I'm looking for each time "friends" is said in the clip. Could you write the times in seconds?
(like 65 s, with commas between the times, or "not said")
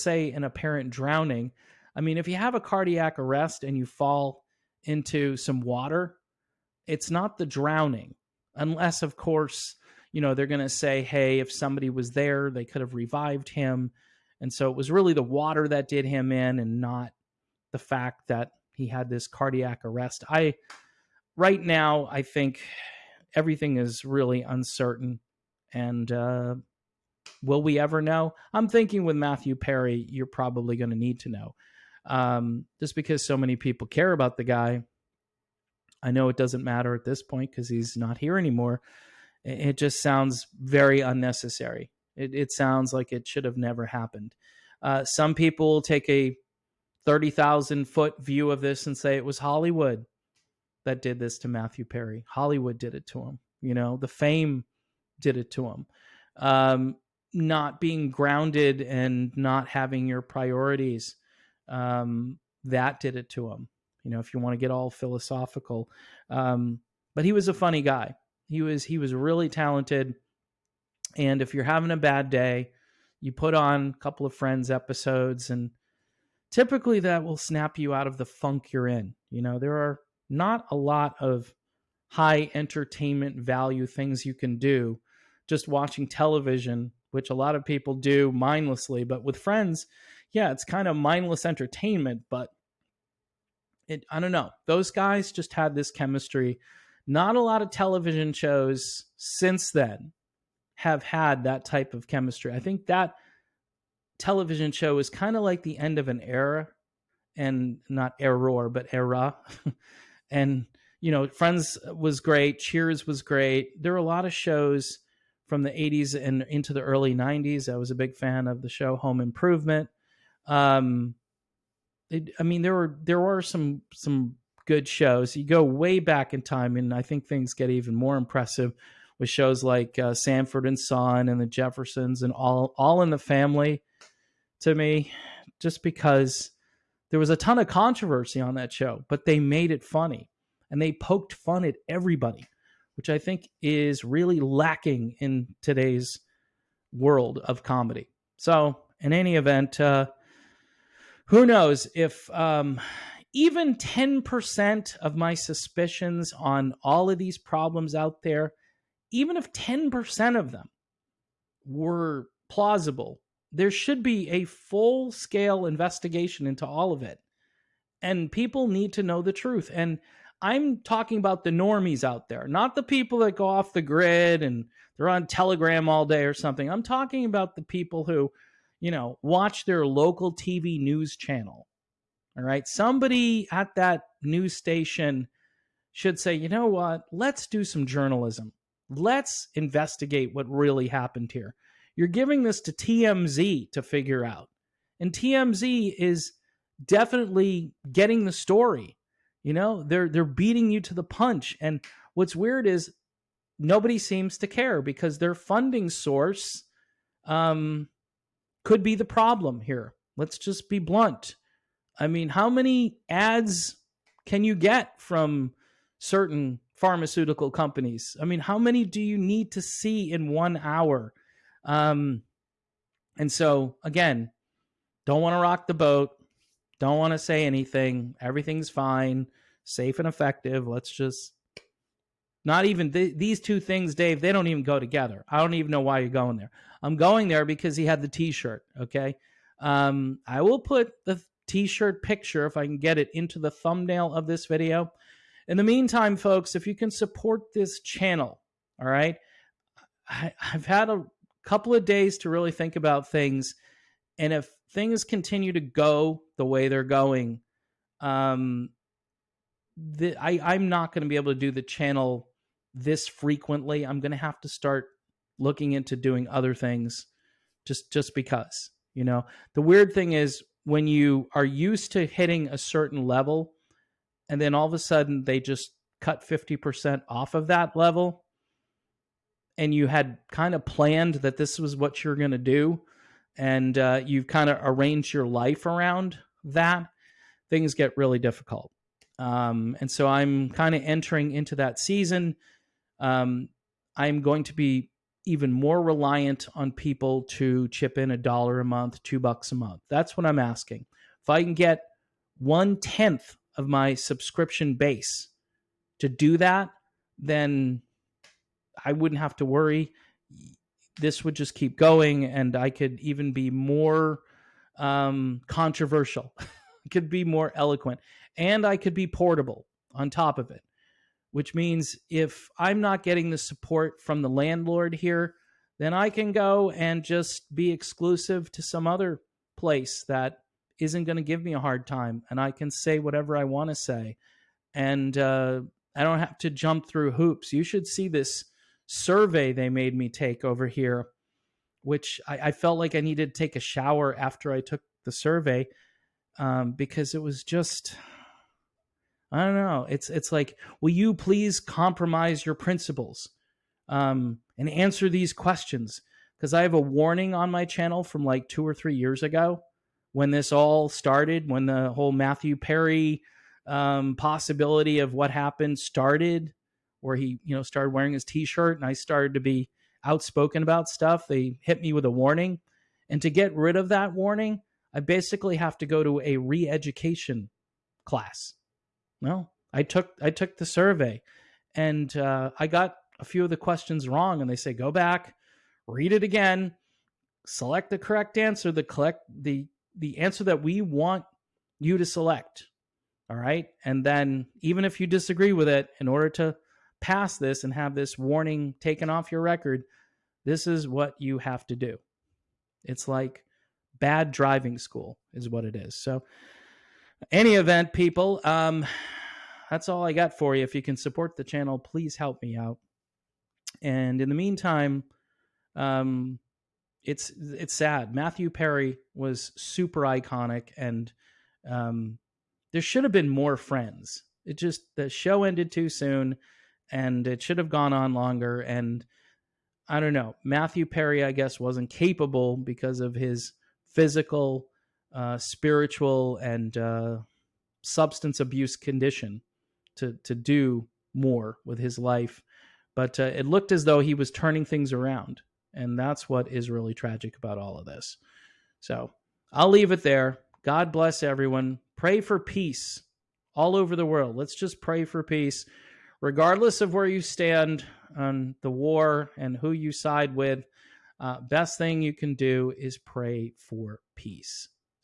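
74 s, 89 s, 111 s, 423 s.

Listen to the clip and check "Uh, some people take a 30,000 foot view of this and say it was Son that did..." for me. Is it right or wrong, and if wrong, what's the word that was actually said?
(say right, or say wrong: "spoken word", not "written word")
wrong: "Hollywood", not "Son".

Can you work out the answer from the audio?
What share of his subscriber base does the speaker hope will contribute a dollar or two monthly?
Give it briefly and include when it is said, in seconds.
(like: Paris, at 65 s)
one tenth, at 302 s.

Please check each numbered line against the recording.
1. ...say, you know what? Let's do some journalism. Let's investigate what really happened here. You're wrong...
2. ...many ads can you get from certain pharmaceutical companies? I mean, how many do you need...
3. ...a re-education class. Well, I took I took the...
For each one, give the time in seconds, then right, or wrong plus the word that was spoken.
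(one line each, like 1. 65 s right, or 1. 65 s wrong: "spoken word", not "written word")
1. 186 s wrong: "giving", not "wrong"
2. 212 s right
3. 376 s right.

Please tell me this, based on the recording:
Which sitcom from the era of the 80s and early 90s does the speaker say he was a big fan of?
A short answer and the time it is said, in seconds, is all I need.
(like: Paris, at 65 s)
Home Improvement, at 118 s.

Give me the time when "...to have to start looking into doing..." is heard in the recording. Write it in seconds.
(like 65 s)
264 s.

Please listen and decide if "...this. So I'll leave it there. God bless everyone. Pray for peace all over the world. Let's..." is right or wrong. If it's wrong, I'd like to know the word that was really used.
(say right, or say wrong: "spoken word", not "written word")
right.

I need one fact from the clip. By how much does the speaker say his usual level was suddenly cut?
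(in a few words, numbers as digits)
50%.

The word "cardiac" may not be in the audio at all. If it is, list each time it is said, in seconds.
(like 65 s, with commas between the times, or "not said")
2 s, 19 s.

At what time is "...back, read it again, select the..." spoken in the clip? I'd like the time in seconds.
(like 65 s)
384 s.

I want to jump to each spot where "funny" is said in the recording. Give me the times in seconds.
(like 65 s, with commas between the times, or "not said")
67 s, 139 s.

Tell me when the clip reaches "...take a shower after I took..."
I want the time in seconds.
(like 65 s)
343 s.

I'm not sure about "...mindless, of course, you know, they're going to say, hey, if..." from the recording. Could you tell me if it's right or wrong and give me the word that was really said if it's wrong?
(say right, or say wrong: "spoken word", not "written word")
wrong: "unless", not "mindless".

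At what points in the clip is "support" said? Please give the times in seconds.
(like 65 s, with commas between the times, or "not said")
246 s, 323 s, 410 s.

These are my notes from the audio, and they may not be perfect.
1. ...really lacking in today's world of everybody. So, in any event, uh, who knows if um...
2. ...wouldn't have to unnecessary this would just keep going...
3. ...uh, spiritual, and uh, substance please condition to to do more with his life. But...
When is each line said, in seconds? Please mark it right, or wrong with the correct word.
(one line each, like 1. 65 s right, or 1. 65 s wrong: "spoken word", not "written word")
1. 144 s wrong: "comedy", not "everybody"
2. 308 s wrong: "worry", not "unnecessary"
3. 435 s wrong: "abuse", not "please".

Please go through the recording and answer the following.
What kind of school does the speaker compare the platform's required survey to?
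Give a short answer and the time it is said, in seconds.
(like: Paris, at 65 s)
bad driving school, at 403 s.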